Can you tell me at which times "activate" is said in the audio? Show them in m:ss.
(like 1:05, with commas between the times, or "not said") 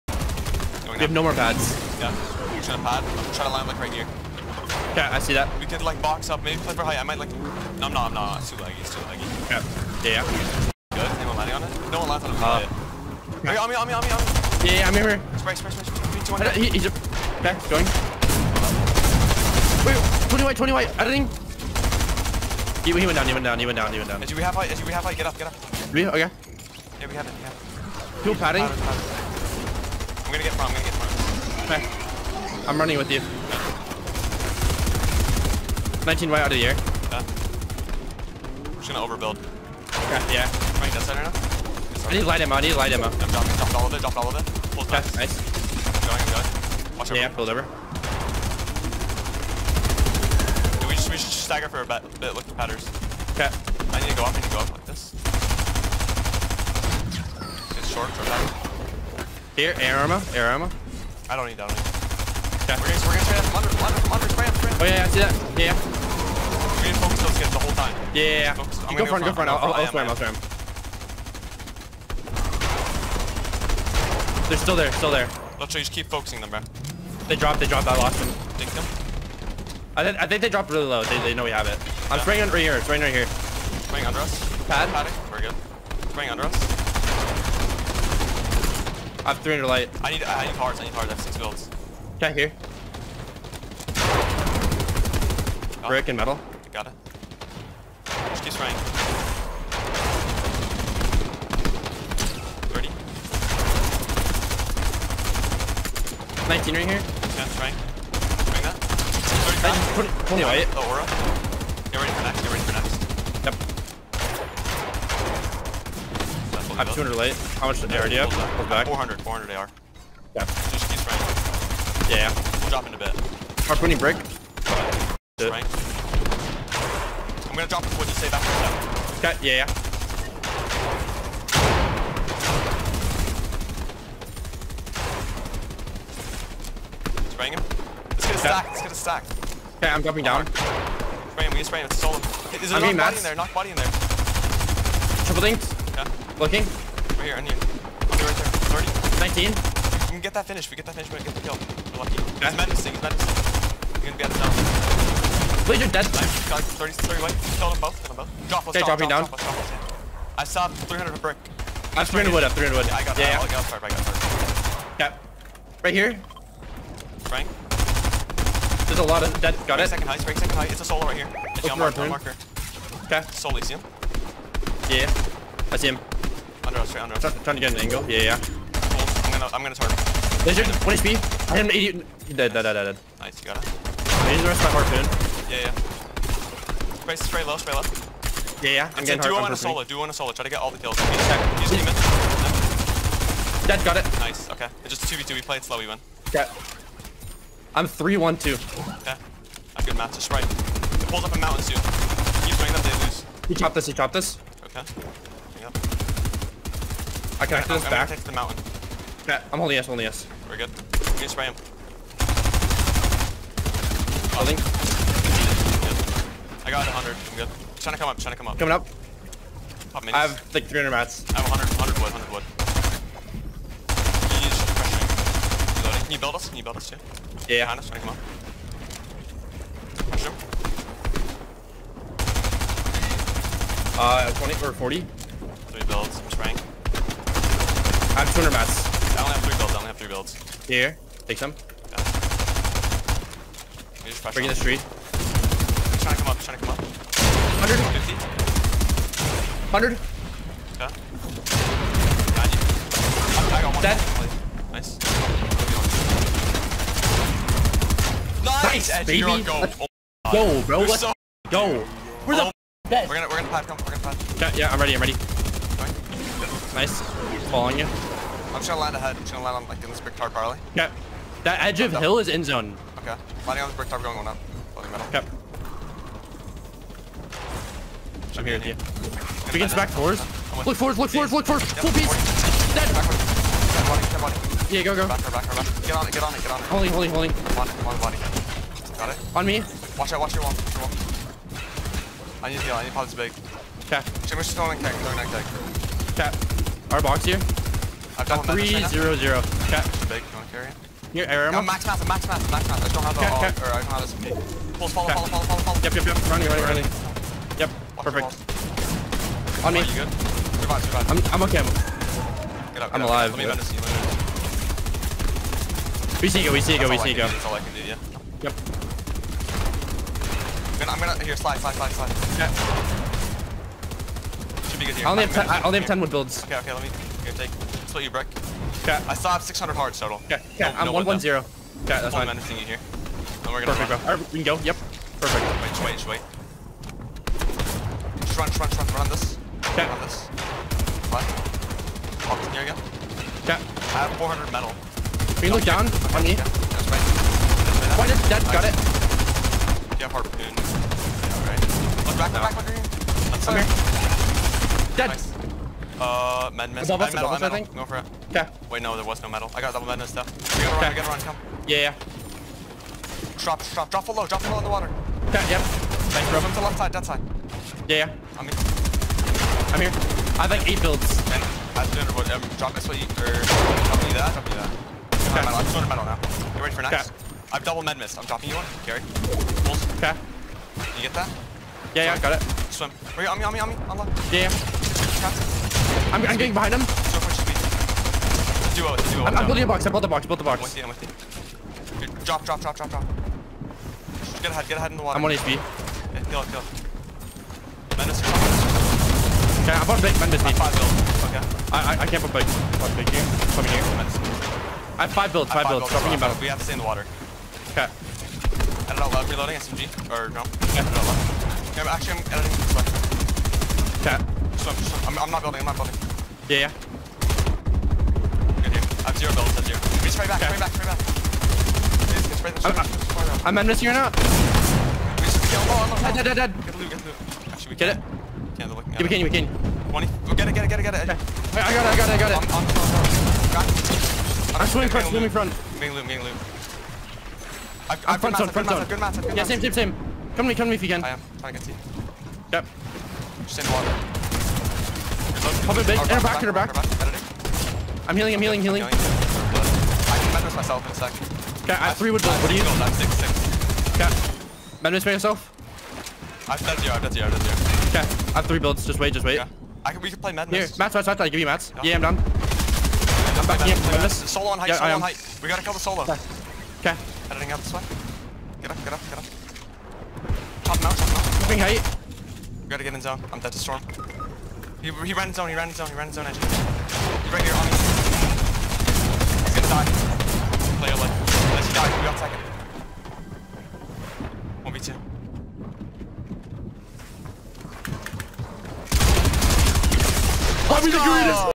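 3:27.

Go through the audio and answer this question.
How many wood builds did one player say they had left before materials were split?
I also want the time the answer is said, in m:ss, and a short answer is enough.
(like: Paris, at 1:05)
10, at 5:25.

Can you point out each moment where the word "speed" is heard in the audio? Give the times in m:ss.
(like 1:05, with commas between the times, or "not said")
6:27.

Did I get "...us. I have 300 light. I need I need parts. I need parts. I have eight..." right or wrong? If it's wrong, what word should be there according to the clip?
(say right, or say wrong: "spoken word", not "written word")
wrong: "six", not "eight".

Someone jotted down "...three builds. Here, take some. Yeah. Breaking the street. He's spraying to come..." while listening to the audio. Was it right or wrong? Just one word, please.
wrong.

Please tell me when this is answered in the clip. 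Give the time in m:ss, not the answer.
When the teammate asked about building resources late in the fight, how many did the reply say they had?
7:32.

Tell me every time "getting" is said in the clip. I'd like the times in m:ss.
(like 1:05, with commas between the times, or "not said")
3:09, 6:26.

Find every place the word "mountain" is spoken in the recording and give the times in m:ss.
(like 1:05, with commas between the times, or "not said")
3:21, 3:28.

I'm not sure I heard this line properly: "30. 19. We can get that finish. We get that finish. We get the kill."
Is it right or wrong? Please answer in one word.
right.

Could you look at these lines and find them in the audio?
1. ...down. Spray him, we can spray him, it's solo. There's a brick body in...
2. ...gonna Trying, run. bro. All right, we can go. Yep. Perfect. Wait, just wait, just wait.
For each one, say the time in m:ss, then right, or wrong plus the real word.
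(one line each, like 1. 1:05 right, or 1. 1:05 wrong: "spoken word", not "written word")
1. 2:20 wrong: "knock", not "brick"
2. 5:33 wrong: "Perfect", not "Trying".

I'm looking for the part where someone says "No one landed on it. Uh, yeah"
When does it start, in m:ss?
0:11.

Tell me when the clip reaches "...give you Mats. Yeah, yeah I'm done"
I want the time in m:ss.
7:41.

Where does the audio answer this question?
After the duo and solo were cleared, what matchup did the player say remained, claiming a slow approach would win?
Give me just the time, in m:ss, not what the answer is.
3:14.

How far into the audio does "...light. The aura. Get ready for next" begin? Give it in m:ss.
1:50.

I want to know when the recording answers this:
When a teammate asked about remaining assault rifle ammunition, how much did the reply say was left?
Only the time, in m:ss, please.
1:58.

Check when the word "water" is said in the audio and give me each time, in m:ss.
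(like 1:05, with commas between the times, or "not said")
6:04, 6:35, 6:46, 7:23.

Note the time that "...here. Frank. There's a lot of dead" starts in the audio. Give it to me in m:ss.
2:45.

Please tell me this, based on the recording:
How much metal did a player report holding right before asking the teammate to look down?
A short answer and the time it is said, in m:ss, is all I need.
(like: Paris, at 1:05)
400, at 5:43.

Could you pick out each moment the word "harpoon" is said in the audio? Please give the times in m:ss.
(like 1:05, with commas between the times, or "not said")
3:04, 5:50.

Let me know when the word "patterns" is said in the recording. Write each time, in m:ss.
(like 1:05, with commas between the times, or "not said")
0:52, 0:58.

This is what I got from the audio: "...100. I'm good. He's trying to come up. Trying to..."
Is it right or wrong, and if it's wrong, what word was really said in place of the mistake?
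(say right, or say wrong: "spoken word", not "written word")
right.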